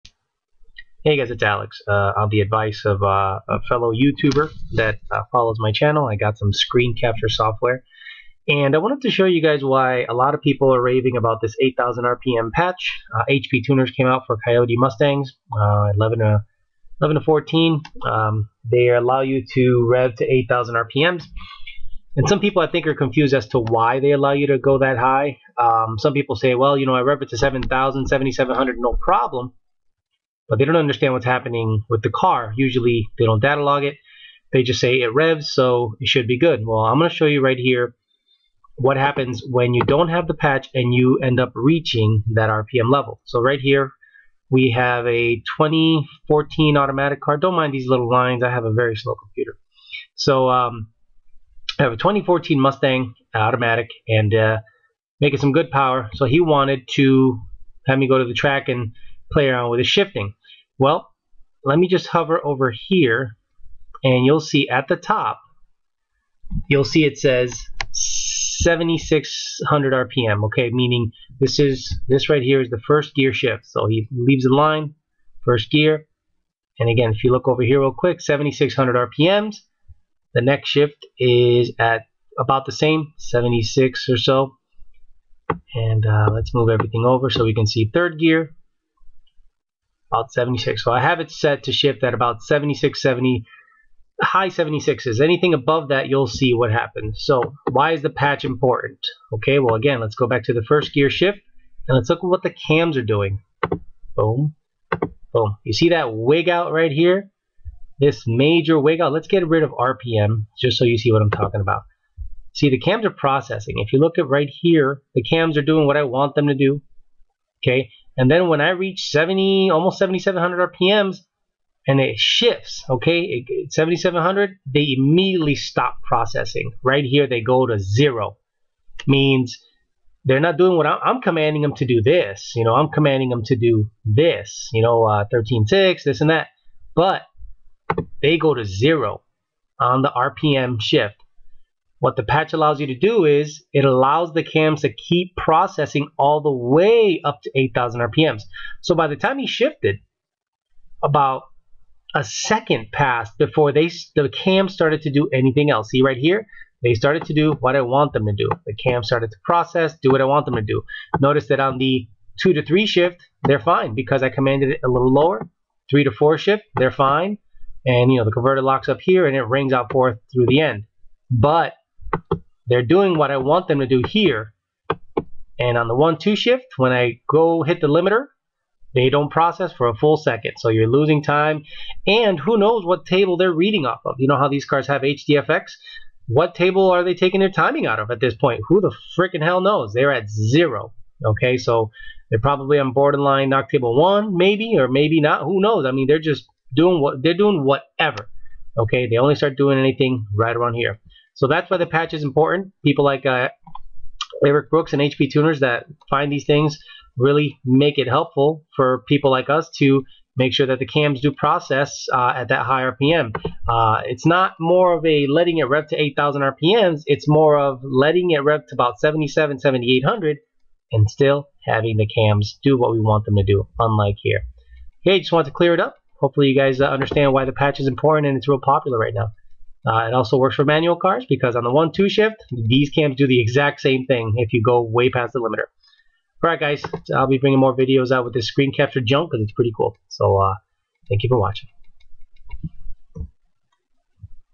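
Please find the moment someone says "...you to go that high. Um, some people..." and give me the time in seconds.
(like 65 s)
24 s.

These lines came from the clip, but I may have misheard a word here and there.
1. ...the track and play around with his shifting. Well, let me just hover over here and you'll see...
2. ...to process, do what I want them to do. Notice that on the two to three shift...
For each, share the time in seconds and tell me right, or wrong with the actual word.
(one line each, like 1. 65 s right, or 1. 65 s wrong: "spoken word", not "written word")
1. 58 s right
2. 159 s right.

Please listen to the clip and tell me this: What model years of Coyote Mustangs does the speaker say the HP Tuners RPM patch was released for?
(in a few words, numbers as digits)
2011 to 2014.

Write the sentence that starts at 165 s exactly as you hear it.
Three to four shift, they're fine.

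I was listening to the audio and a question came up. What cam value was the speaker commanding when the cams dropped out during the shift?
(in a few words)
13.6.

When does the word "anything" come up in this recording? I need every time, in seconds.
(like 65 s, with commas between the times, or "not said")
95 s, 155 s, 199 s.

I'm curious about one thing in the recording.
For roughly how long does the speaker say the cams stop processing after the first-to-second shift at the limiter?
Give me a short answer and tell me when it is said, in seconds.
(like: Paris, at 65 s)
A second, at 152 s.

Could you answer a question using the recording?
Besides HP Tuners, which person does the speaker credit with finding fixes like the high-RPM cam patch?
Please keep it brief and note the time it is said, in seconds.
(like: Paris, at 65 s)
Eric Brooks, at 204 s.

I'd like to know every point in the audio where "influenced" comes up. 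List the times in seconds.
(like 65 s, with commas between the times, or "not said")
not said.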